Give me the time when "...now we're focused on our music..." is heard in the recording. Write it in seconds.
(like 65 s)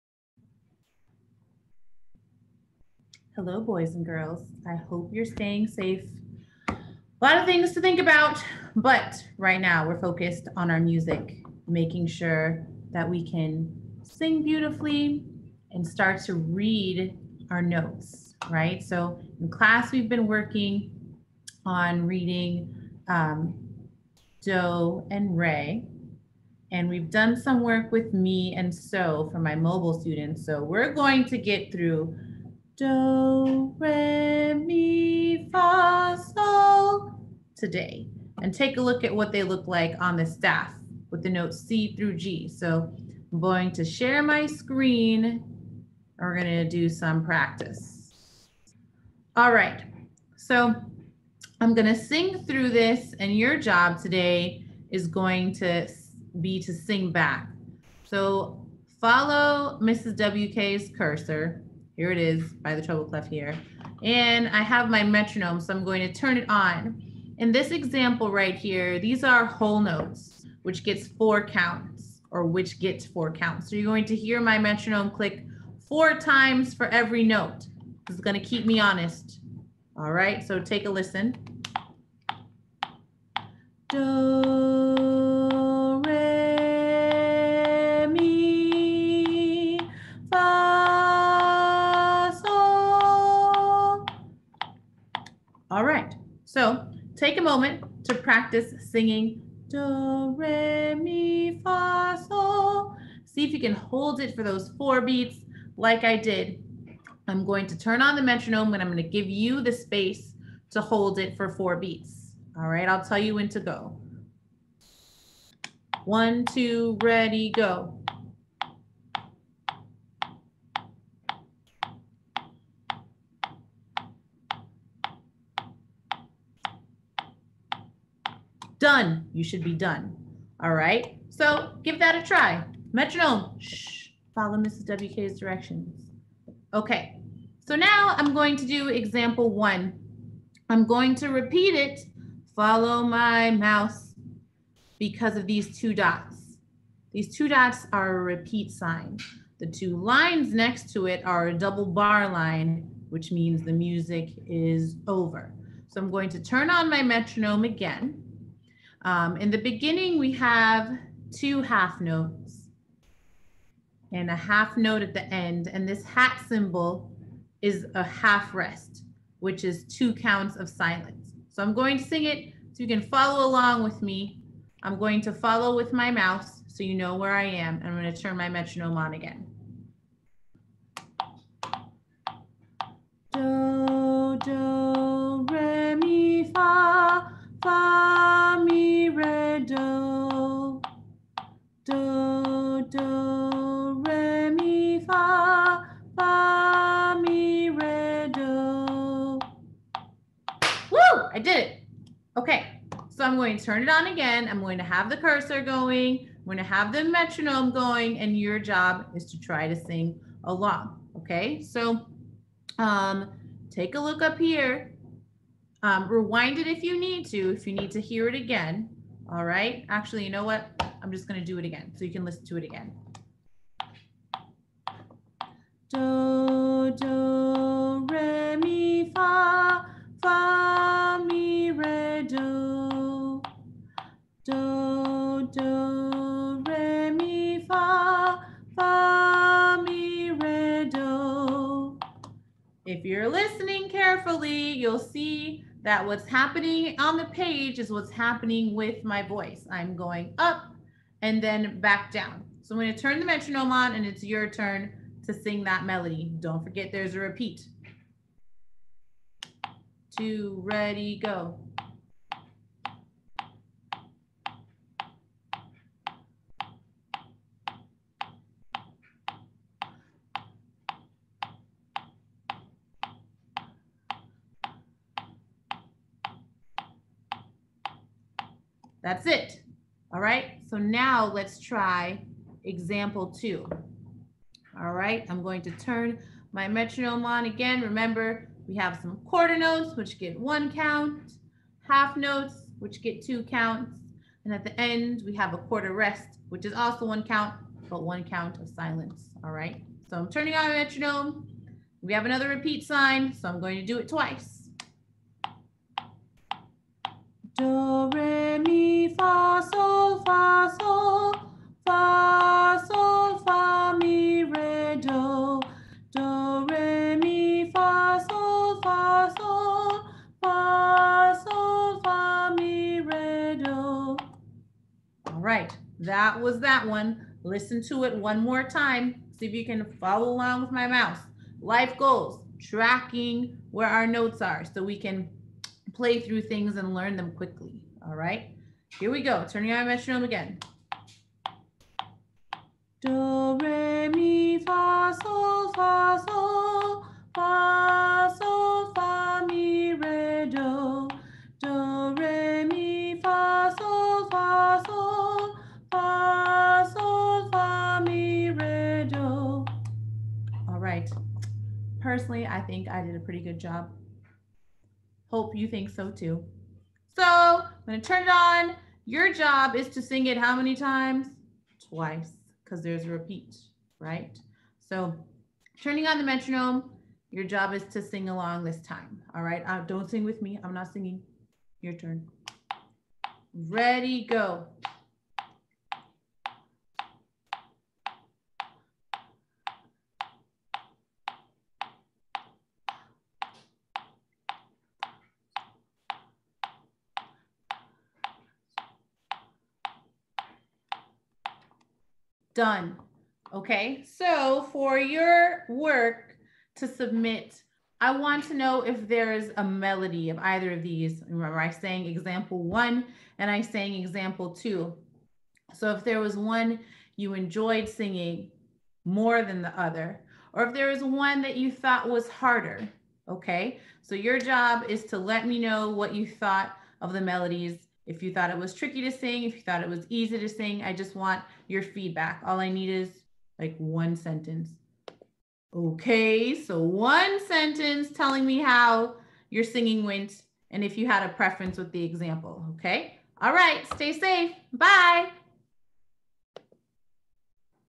9 s.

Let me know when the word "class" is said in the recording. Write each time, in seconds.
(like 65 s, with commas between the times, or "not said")
19 s.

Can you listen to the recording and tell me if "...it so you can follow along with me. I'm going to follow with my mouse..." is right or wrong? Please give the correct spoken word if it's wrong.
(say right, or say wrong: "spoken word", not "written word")
right.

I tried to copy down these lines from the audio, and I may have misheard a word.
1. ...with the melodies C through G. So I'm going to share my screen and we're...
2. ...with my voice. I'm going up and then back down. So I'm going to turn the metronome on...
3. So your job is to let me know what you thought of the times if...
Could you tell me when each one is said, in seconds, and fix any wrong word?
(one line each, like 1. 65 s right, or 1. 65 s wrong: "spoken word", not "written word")
1. 41 s wrong: "notes", not "melodies"
2. 248 s right
3. 424 s wrong: "melodies", not "times".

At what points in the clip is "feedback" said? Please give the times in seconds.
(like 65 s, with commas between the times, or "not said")
431 s.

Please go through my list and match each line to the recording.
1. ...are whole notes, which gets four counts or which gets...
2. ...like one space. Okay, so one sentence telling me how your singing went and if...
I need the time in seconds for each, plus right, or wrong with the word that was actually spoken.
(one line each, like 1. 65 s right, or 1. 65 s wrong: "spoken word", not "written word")
1. 69 s right
2. 433 s wrong: "sentence", not "space".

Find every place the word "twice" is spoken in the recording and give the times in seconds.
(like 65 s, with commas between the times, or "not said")
304 s, 371 s.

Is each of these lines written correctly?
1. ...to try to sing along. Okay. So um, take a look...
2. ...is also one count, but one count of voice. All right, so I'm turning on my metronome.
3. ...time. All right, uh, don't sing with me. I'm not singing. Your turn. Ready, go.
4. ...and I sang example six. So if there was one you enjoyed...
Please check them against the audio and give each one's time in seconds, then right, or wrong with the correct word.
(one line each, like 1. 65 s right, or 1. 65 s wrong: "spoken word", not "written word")
1. 209 s right
2. 296 s wrong: "silence", not "voice"
3. 378 s right
4. 413 s wrong: "two", not "six".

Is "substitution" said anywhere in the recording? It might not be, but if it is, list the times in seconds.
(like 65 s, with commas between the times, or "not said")
not said.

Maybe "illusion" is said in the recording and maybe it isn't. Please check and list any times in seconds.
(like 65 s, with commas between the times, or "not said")
not said.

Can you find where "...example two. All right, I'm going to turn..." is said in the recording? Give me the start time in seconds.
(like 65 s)
282 s.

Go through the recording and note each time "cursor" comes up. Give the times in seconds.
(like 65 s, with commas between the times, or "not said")
60 s, 205 s.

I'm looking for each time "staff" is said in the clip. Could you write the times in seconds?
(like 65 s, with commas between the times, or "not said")
40 s.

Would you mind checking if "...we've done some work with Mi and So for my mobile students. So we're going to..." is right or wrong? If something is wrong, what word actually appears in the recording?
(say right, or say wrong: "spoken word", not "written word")
right.